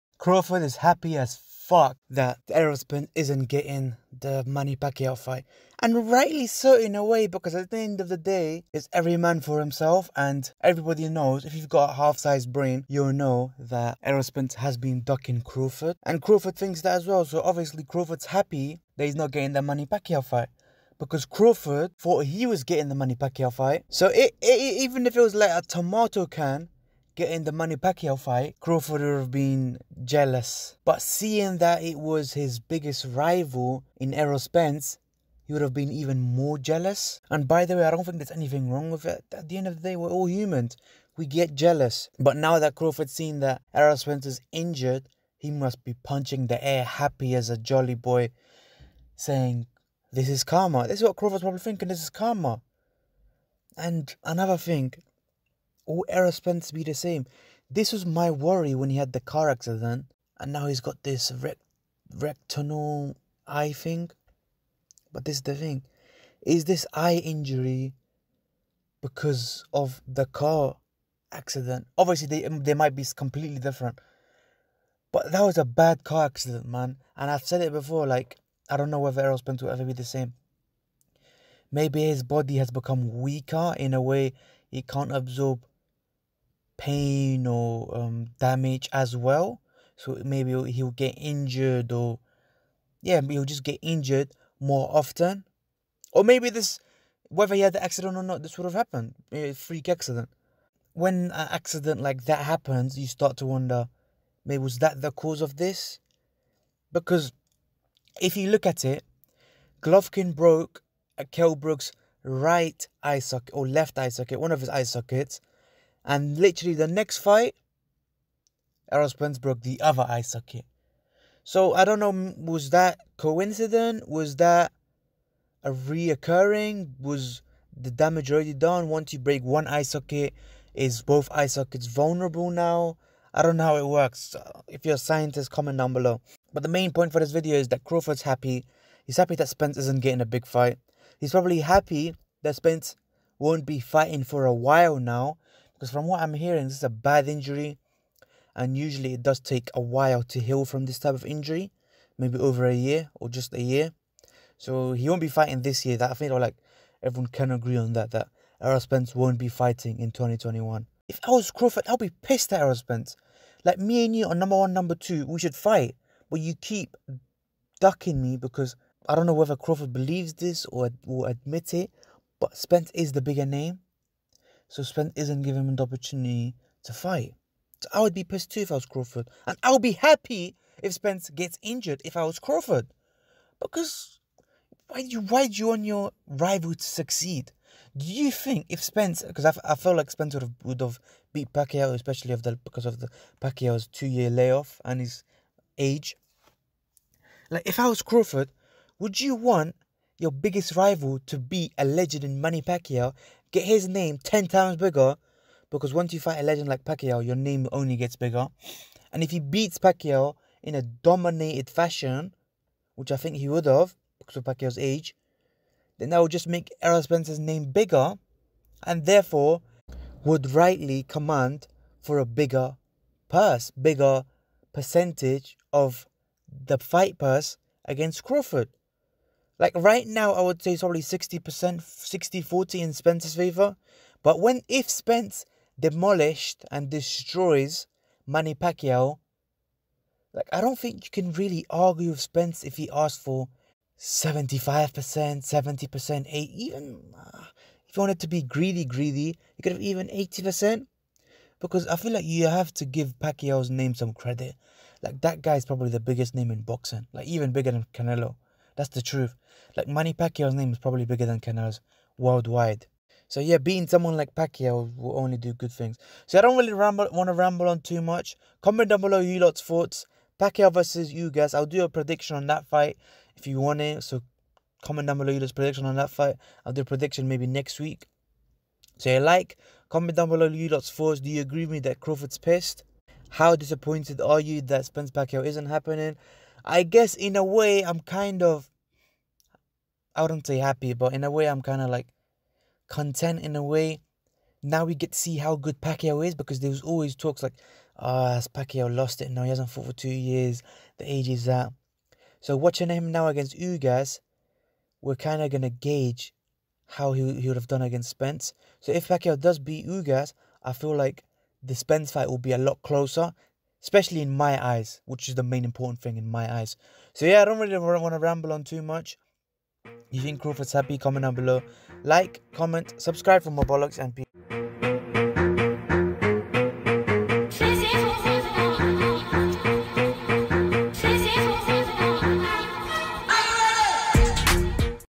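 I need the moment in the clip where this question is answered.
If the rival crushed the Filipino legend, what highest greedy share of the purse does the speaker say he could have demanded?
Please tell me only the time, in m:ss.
4:10.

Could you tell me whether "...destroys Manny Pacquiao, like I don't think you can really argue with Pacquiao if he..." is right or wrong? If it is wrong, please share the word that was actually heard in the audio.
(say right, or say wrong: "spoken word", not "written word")
wrong: "Spence", not "Pacquiao".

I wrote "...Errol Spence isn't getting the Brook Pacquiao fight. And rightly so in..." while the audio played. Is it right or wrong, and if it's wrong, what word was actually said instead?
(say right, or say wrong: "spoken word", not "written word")
wrong: "Manny", not "Brook".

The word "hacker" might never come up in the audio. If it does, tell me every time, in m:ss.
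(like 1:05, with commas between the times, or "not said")
not said.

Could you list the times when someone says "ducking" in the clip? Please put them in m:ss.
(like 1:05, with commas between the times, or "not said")
0:15, 2:47.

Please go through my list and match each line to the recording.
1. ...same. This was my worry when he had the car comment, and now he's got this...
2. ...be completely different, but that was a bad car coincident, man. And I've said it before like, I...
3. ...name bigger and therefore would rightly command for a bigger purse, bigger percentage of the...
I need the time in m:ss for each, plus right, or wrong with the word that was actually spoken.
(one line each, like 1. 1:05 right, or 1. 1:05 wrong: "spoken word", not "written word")
1. 0:56 wrong: "accident", not "comment"
2. 1:12 wrong: "accident", not "coincident"
3. 3:37 right.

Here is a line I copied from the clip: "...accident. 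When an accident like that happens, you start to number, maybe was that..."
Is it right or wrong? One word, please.
wrong.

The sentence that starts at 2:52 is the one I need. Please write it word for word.
But Spence is the bigger name so Spence isn't giving him the opportunity to fight.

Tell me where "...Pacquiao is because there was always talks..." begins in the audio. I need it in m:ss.
4:55.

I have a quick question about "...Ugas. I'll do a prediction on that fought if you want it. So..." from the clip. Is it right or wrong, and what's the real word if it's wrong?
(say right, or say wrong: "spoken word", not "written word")
wrong: "fight", not "fought".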